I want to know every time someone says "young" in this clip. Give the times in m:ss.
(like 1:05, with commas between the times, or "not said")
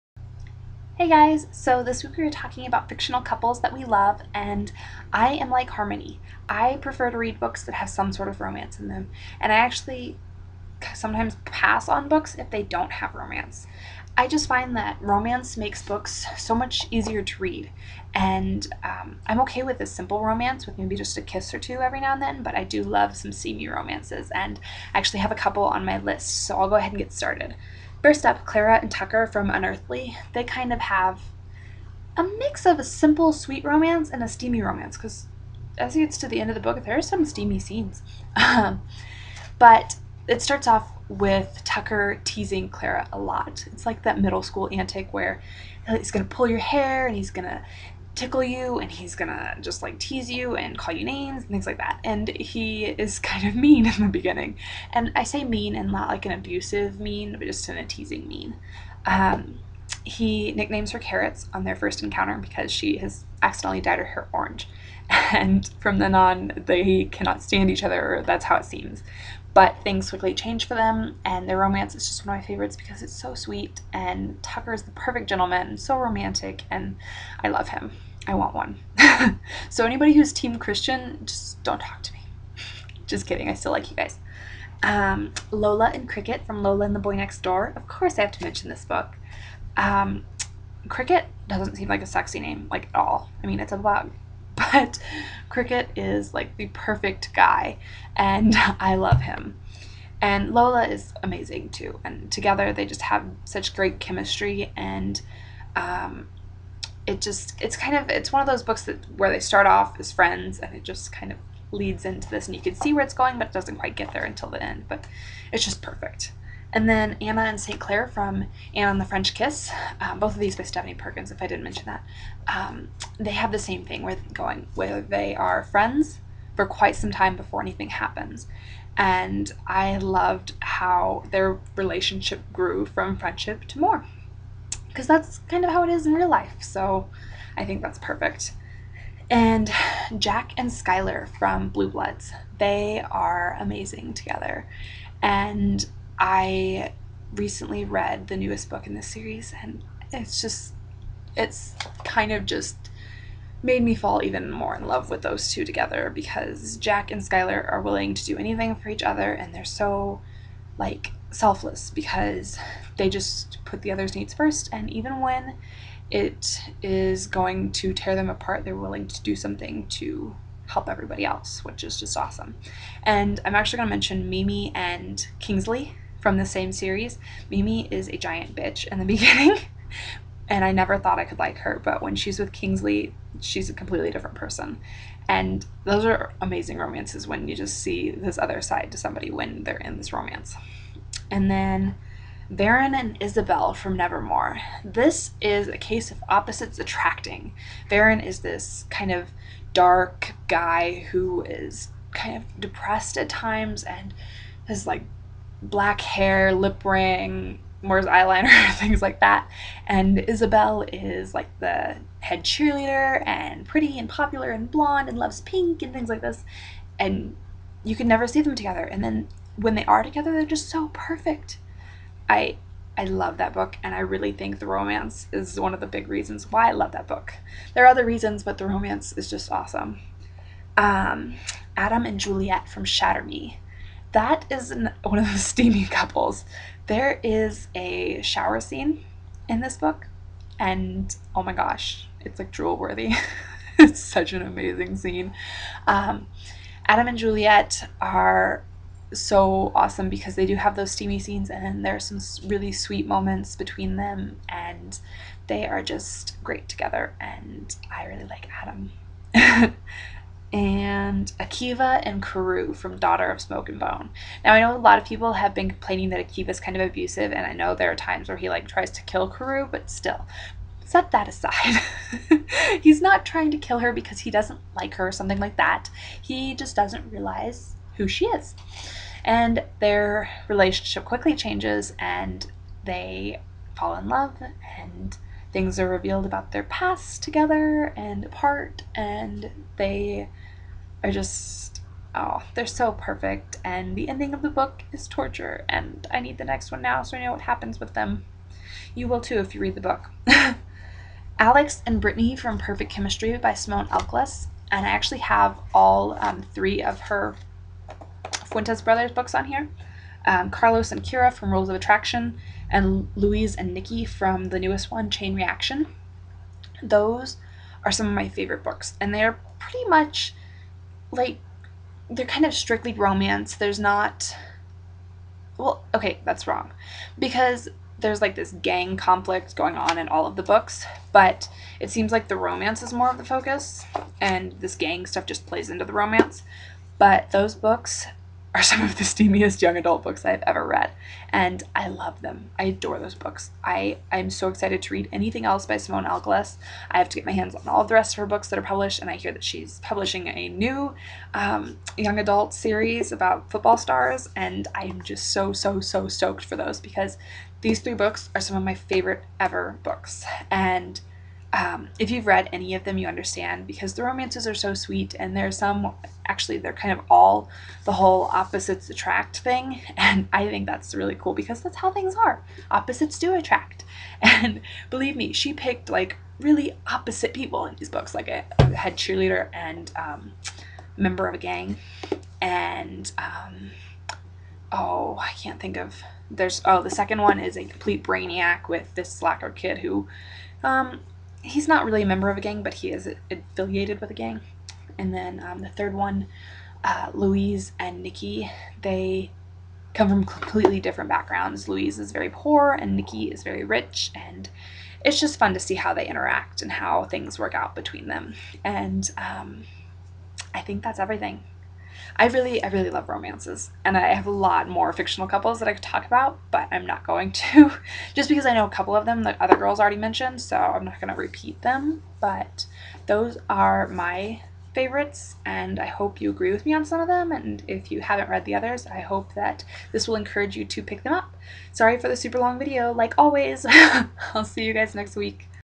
5:39, 5:51.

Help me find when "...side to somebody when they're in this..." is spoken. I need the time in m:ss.
3:08.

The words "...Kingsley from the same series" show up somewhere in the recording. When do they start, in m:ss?
2:55.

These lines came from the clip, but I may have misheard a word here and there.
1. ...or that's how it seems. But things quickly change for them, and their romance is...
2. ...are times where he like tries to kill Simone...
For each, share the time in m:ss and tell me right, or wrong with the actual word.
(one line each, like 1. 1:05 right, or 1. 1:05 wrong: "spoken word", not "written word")
1. 1:08 right
2. 4:27 wrong: "Karou", not "Simone".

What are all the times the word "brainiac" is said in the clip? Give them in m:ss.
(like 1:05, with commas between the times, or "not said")
6:28.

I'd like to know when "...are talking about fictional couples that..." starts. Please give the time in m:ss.
0:02.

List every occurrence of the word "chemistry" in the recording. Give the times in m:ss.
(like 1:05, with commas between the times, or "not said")
1:43, 5:02.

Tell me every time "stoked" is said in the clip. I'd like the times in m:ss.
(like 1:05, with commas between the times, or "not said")
5:56.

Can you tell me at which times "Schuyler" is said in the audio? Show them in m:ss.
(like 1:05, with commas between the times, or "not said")
2:20, 2:37.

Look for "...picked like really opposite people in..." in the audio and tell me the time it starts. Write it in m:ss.
6:15.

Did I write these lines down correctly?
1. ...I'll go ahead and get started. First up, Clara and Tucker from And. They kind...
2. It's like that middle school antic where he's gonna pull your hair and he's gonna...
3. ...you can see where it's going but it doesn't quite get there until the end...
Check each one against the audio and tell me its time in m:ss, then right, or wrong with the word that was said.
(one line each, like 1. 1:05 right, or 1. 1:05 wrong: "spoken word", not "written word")
1. 0:26 wrong: "Unearthly", not "And"
2. 0:43 right
3. 1:52 right.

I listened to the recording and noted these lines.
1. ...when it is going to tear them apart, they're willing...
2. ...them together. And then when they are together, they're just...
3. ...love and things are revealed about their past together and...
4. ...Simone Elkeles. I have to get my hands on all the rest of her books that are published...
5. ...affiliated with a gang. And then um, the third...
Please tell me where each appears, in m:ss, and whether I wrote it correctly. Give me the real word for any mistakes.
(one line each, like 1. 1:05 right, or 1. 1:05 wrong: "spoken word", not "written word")
1. 2:45 right
2. 3:38 right
3. 4:44 right
4. 5:45 right
5. 6:33 right.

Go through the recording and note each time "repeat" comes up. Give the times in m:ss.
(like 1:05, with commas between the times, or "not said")
7:01.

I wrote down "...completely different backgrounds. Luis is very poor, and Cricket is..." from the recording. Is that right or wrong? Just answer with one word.
wrong.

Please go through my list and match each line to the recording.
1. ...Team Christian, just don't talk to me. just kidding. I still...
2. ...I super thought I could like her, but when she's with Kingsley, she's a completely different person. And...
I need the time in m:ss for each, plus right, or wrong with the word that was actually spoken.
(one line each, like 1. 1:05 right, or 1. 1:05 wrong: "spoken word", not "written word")
1. 1:20 right
2. 3:00 wrong: "never", not "super".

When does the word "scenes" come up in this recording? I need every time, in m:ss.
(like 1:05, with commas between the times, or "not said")
0:37, 3:58, 4:04, 4:11.